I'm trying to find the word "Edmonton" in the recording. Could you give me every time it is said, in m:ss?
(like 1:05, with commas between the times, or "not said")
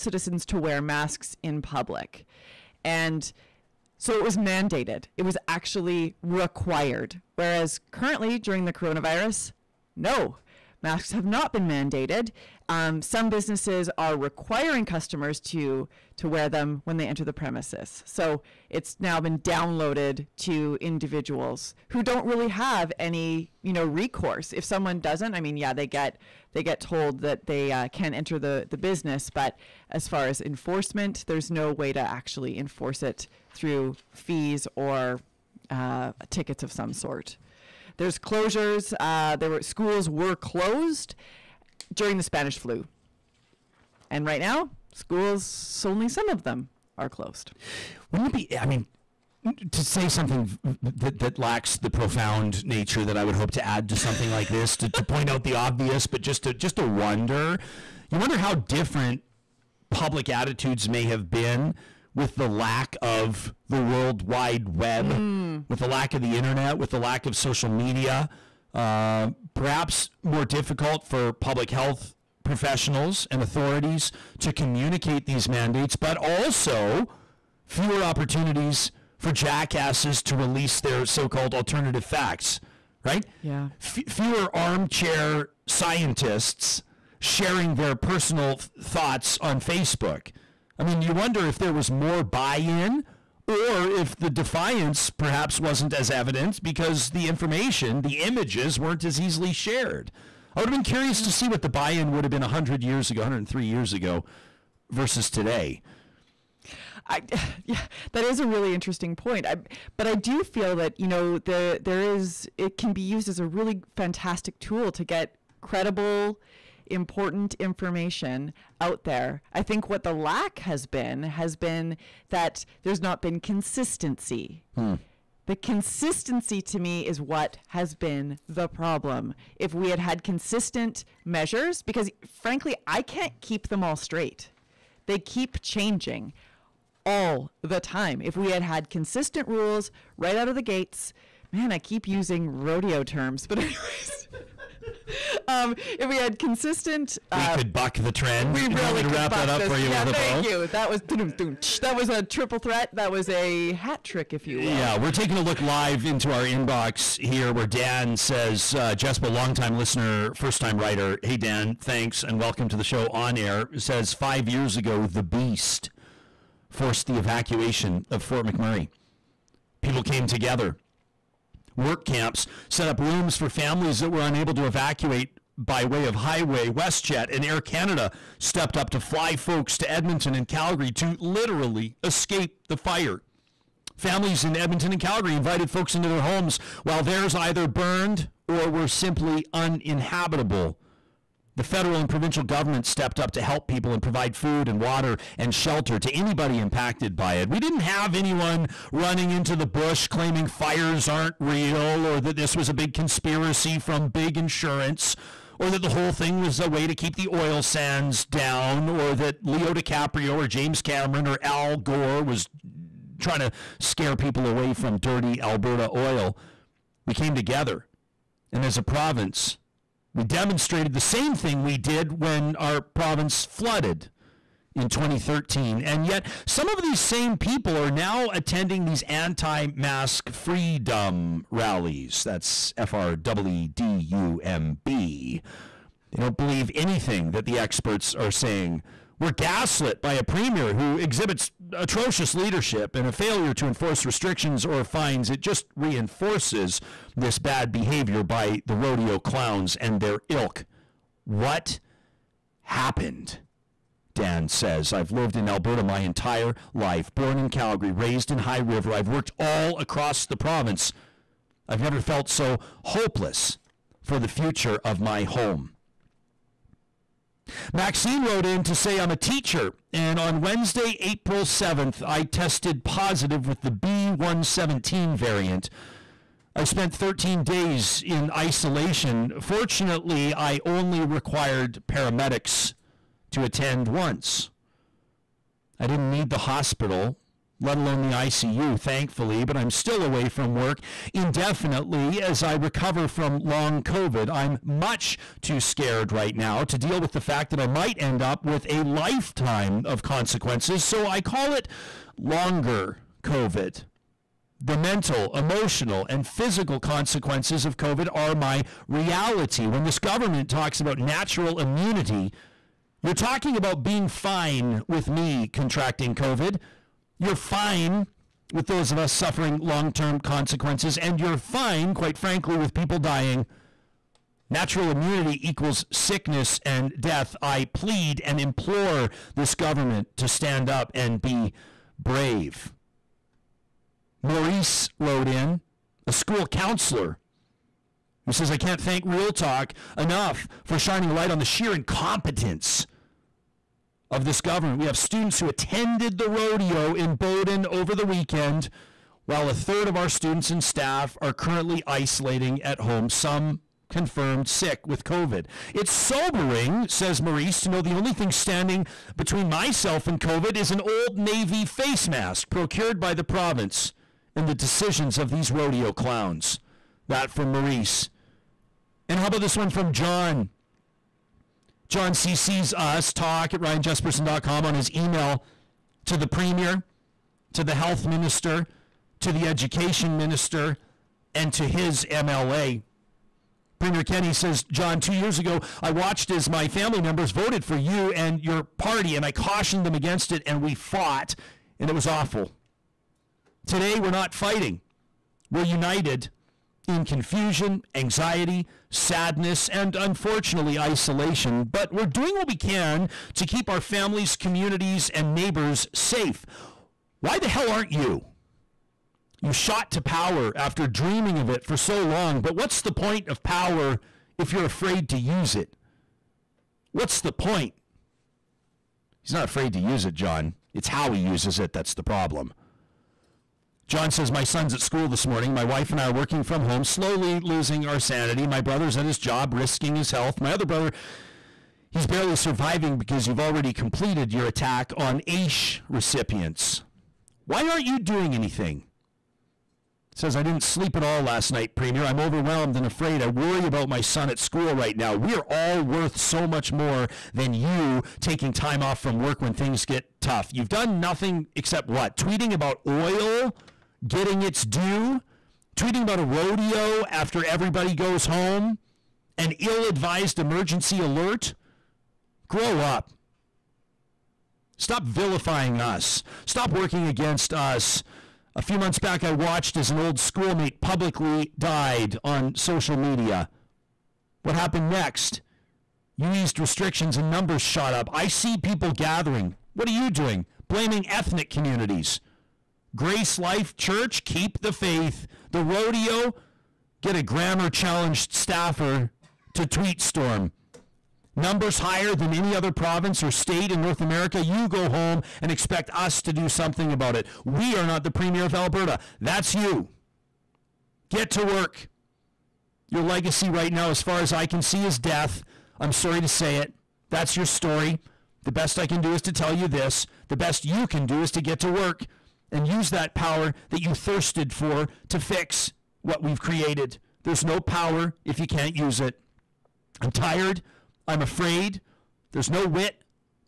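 2:59, 3:04.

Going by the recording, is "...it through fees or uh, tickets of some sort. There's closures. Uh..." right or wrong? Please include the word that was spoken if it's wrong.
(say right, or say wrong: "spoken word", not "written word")
right.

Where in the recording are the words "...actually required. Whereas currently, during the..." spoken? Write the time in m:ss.
0:05.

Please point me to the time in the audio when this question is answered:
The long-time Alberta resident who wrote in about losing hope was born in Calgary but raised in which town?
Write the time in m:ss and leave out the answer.
4:18.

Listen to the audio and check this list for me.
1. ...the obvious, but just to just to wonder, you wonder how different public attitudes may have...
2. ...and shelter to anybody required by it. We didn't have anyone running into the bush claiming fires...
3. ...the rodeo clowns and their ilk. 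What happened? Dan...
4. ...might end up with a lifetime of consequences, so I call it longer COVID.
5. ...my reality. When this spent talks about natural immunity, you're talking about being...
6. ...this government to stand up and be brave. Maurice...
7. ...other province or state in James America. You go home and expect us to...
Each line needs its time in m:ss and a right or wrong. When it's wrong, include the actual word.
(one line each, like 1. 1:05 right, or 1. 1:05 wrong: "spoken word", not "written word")
1. 0:55 right
2. 3:15 wrong: "impacted", not "required"
3. 4:08 right
4. 4:57 right
5. 5:08 wrong: "government", not "spent"
6. 5:29 right
7. 8:12 wrong: "North", not "James".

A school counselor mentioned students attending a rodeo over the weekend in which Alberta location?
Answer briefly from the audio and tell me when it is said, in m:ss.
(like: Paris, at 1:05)
Bowden, at 5:47.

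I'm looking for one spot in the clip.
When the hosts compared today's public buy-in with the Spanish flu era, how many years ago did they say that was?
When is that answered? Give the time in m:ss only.
1:43.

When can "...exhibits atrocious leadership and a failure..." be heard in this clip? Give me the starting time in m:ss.
4:00.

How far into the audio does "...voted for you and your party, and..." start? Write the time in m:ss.
6:27.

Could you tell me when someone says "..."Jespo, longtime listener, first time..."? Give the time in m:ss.
2:38.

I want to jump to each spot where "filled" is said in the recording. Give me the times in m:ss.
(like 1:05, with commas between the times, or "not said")
not said.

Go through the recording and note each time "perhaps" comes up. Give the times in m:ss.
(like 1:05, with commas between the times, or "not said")
1:09, 1:35.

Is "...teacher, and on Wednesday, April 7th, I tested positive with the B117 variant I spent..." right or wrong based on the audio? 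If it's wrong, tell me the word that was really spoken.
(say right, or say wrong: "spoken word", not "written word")
right.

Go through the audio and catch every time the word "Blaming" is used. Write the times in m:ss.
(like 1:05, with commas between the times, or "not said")
8:00.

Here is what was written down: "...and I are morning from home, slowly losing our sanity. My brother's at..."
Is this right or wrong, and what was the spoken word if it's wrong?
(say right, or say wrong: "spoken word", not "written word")
wrong: "working", not "morning".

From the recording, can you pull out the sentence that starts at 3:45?
And yet, some of these same people are now attending these anti mask freedom rallies.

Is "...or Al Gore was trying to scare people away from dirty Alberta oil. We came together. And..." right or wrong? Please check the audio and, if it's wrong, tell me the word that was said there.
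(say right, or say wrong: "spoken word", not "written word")
right.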